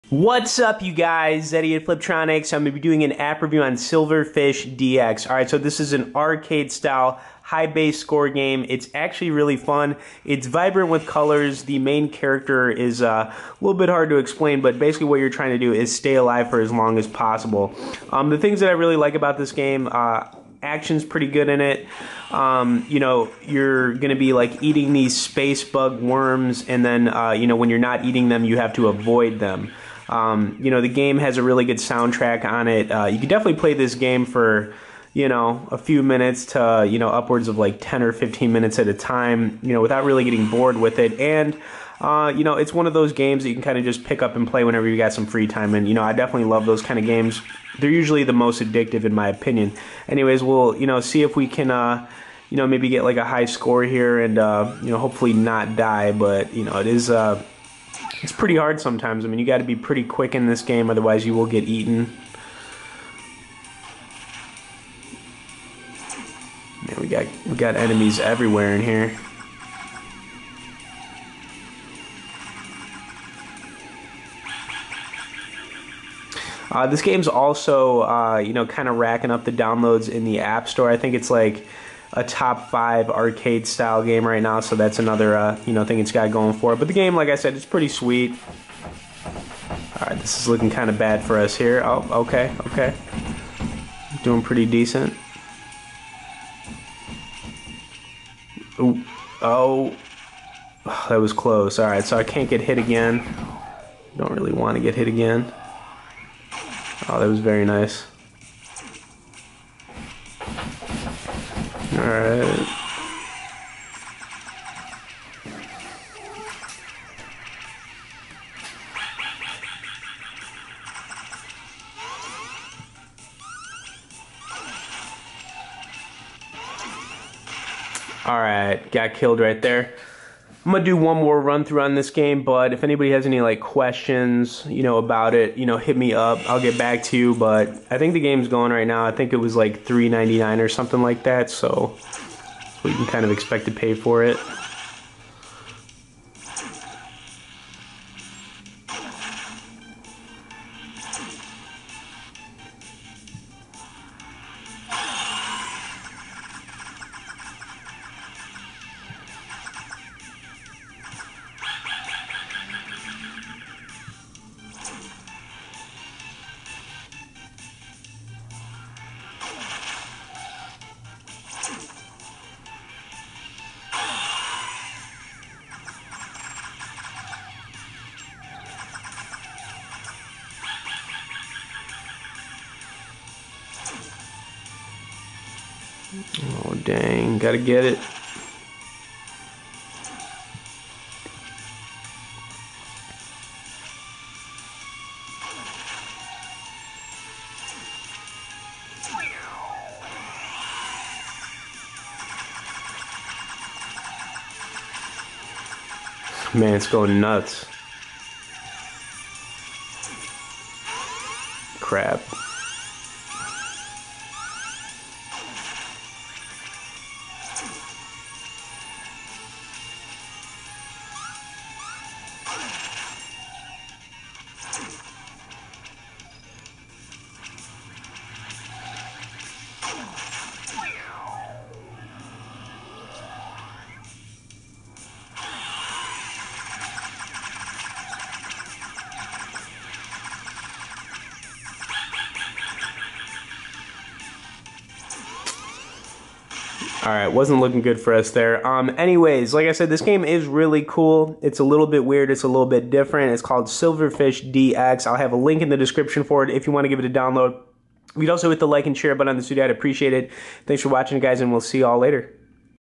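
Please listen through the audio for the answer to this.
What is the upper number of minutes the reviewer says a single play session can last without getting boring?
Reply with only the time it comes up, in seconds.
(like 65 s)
38 s.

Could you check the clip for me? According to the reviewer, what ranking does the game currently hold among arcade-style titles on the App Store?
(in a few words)
top five.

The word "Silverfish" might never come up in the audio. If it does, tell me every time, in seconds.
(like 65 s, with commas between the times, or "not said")
3 s, 253 s.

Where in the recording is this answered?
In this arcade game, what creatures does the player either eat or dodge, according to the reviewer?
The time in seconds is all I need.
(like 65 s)
25 s.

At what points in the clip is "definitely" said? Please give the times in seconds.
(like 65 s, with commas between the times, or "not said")
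33 s, 46 s.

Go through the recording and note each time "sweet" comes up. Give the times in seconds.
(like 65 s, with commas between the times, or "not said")
87 s.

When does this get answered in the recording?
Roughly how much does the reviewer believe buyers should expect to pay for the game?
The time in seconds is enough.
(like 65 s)
139 s.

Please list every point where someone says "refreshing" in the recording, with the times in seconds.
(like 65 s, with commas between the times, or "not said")
not said.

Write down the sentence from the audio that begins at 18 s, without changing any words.
Um, the things that I really like about this game, uh, action's pretty good in it.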